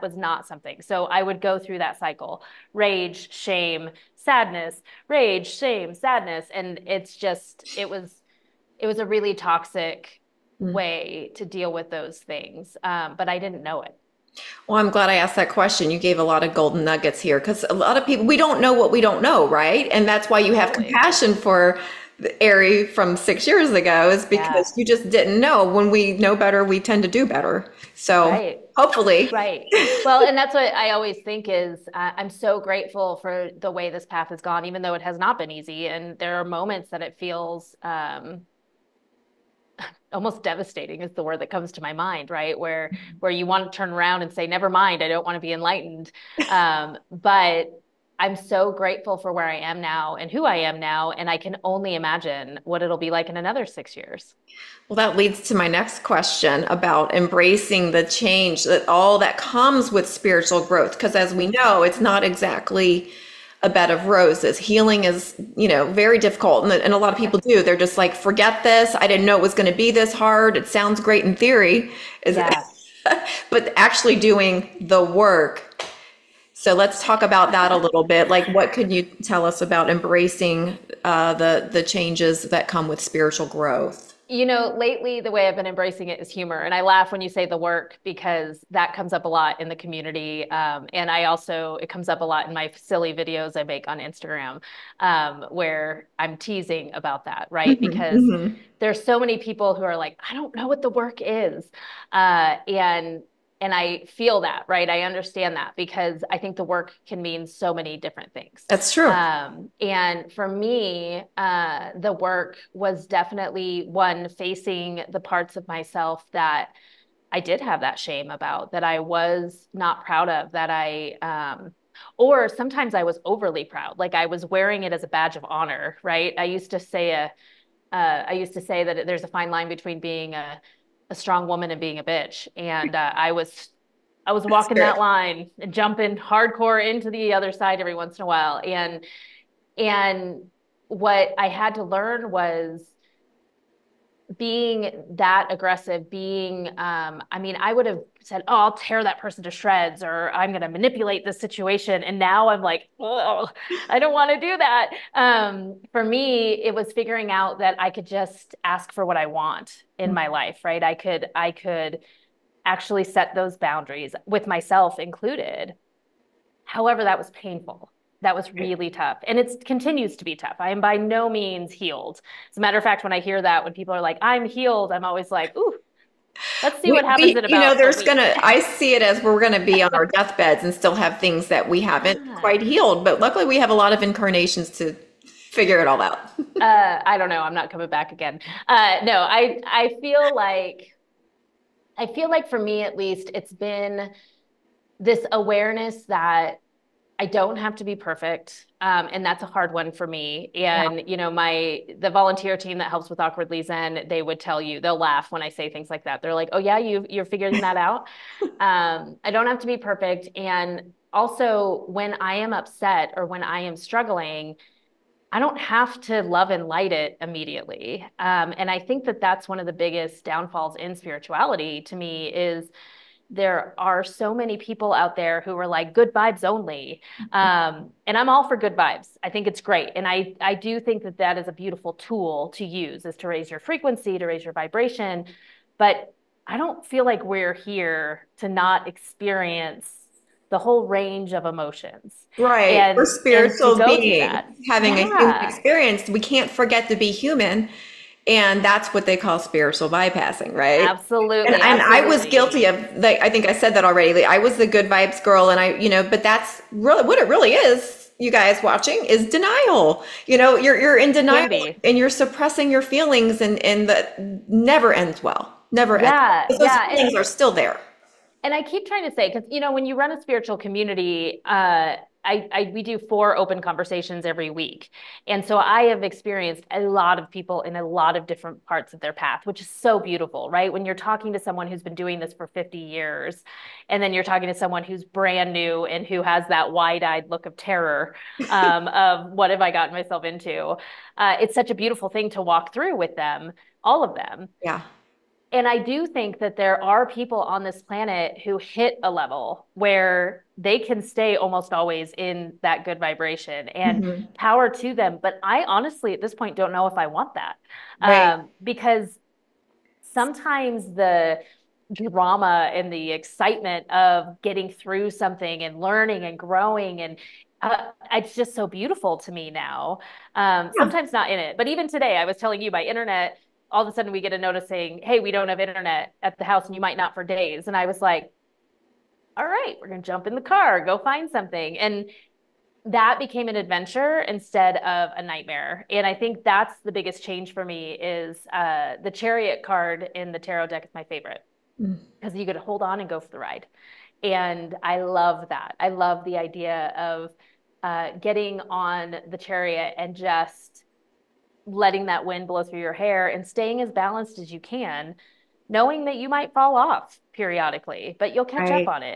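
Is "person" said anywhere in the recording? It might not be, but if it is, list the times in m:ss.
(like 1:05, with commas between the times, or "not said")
2:29.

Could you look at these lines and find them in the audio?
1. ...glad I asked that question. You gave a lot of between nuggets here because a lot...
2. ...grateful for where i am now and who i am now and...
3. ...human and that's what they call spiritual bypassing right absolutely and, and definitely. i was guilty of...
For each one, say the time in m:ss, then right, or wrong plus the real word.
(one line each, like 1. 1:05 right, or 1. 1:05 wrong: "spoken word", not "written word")
1. 0:14 wrong: "golden", not "between"
2. 0:48 right
3. 4:07 wrong: "absolutely", not "definitely".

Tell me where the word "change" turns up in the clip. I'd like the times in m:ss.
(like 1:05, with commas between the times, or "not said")
0:58, 1:21, 5:37.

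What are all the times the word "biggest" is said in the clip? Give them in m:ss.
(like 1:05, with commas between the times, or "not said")
3:39, 5:36.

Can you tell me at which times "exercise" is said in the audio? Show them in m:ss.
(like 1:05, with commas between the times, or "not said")
not said.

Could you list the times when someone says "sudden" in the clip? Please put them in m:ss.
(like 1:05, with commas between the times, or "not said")
5:23.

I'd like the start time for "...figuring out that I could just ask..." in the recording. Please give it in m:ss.
2:36.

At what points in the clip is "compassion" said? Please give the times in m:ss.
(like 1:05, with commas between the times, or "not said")
0:20.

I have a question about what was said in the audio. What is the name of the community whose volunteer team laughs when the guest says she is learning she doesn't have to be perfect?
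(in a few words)
Awkwardly Zen.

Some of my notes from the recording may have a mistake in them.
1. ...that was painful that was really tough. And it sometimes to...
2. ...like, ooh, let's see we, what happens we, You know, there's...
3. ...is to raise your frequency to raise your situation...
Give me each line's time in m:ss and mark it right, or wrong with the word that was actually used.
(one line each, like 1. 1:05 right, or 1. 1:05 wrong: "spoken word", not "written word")
1. 2:47 wrong: "continues", not "sometimes"
2. 2:55 right
3. 3:53 wrong: "vibration", not "situation".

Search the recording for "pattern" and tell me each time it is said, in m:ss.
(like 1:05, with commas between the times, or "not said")
not said.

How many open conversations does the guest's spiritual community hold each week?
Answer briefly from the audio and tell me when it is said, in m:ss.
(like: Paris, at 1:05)
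4, at 4:32.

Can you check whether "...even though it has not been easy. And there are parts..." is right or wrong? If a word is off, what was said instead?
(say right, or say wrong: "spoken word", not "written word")
wrong: "moments", not "parts".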